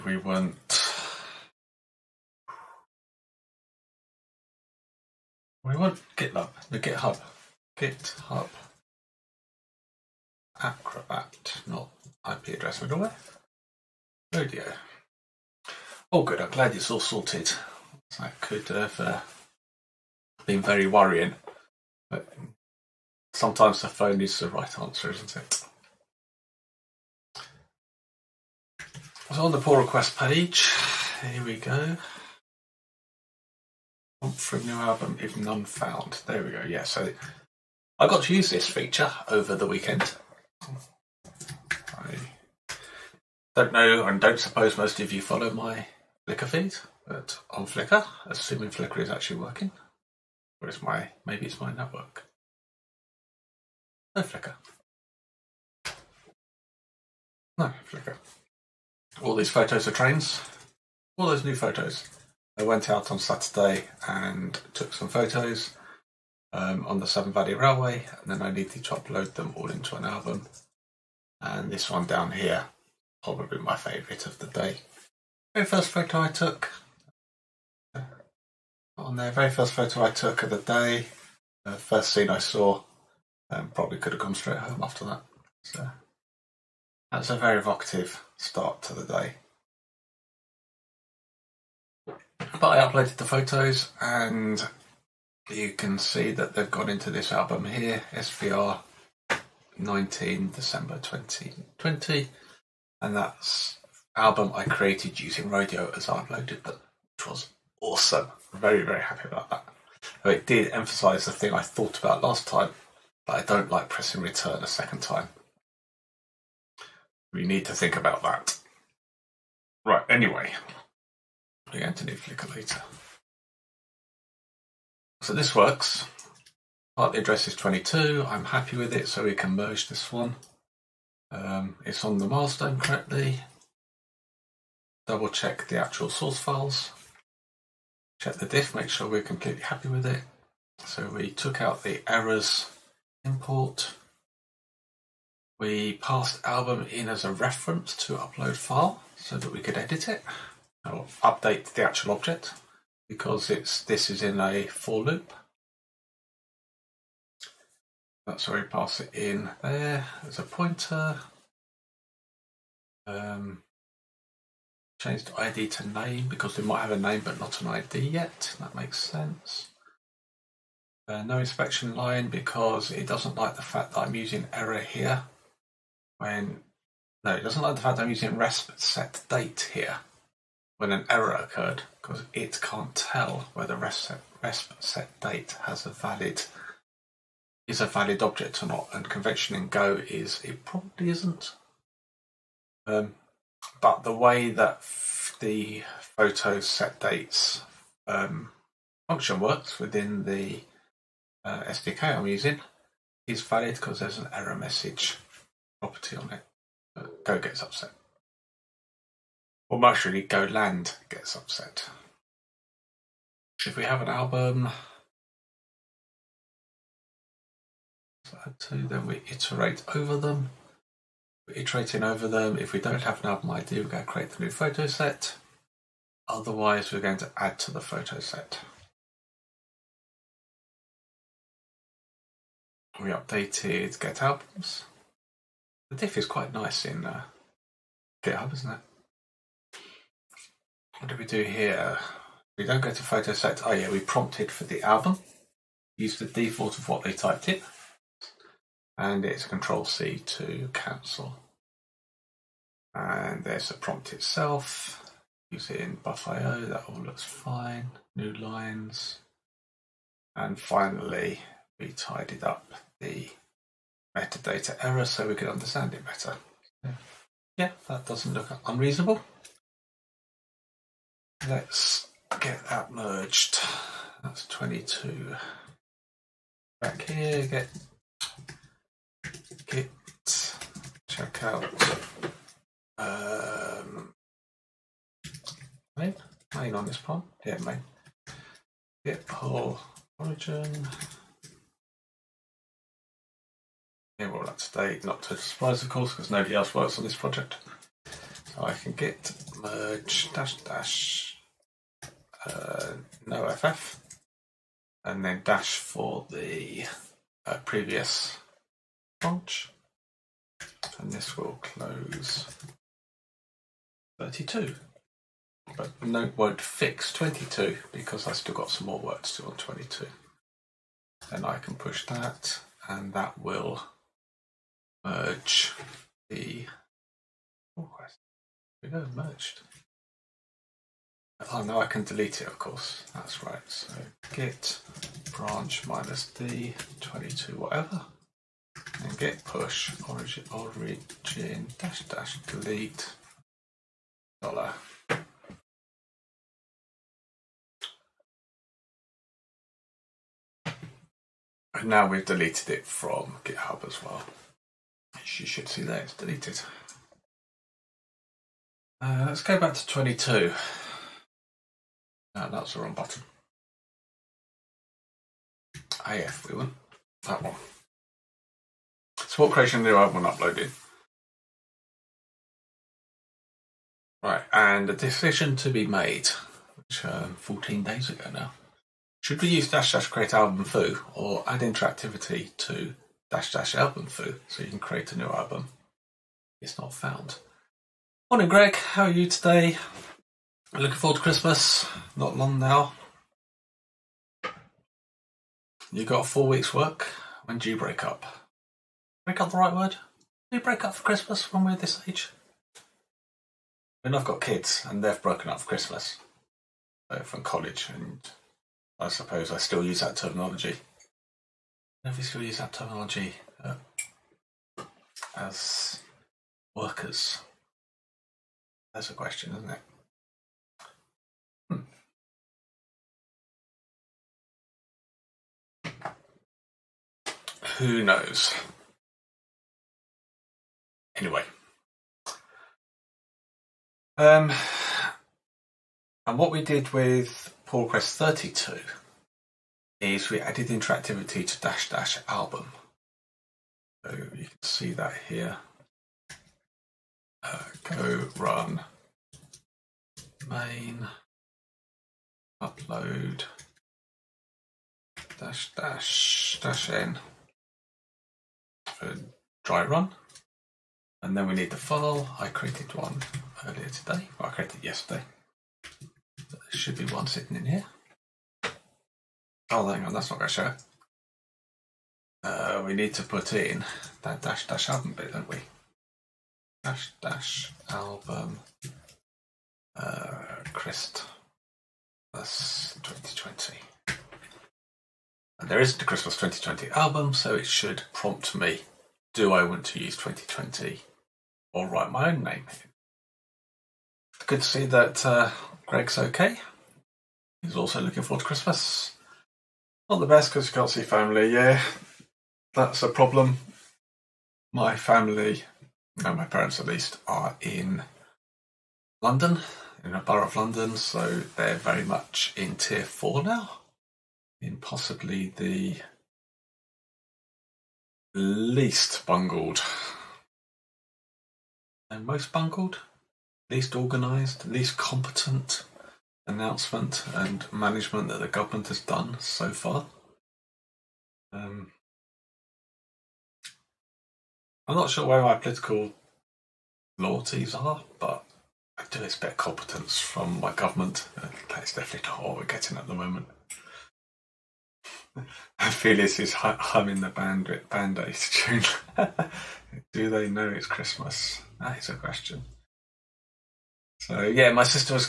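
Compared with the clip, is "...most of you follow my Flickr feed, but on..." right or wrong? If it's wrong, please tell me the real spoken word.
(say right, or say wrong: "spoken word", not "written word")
right.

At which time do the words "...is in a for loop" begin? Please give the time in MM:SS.
02:34.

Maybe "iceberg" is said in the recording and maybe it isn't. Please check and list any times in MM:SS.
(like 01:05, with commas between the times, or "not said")
not said.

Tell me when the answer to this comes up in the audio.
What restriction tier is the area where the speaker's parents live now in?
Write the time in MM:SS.
08:32.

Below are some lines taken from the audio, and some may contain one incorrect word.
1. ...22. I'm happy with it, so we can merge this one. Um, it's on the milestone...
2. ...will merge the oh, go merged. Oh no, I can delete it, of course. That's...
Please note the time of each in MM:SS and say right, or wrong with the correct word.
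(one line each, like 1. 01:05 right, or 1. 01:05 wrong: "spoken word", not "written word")
1. 02:07 right
2. 05:23 right.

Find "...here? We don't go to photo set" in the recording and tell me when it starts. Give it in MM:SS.
04:01.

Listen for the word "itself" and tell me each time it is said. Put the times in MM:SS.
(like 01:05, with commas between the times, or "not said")
04:14.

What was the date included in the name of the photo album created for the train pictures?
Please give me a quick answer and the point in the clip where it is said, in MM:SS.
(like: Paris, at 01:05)
19 December 2020, at 01:39.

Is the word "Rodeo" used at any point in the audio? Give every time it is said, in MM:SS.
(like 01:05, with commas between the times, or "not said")
00:14, 01:45.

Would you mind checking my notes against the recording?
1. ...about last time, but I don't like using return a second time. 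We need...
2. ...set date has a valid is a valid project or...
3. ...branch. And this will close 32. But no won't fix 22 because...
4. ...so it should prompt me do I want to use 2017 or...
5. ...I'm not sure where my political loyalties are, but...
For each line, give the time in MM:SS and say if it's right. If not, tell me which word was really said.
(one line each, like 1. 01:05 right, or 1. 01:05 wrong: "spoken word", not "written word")
1. 01:51 wrong: "pressing", not "using"
2. 03:04 wrong: "object", not "project"
3. 05:09 right
4. 08:07 wrong: "2020", not "2017"
5. 08:54 right.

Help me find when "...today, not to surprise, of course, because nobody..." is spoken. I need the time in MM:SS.
04:54.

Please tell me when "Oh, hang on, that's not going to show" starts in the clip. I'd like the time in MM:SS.
07:49.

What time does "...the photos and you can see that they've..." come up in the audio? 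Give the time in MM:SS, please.
01:33.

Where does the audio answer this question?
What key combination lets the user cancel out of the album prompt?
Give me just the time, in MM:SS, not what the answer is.
04:09.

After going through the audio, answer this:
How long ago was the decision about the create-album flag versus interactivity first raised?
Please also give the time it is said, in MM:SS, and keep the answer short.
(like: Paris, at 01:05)
14 days, at 06:17.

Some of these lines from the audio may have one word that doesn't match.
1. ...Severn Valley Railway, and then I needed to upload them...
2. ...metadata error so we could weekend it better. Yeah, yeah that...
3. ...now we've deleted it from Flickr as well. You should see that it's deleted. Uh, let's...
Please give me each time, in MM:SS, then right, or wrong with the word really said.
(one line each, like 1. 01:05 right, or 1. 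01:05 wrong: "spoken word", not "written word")
1. 01:07 right
2. 04:24 wrong: "understand", not "weekend"
3. 05:51 wrong: "GitHub", not "Flickr".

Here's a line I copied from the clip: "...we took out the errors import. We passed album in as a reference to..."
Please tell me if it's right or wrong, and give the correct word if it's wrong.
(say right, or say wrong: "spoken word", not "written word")
right.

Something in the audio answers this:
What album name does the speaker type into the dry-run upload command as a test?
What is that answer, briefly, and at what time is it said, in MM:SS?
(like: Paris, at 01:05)
Christmas 2020, at 08:00.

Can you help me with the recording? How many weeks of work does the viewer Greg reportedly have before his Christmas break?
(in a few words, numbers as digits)
4.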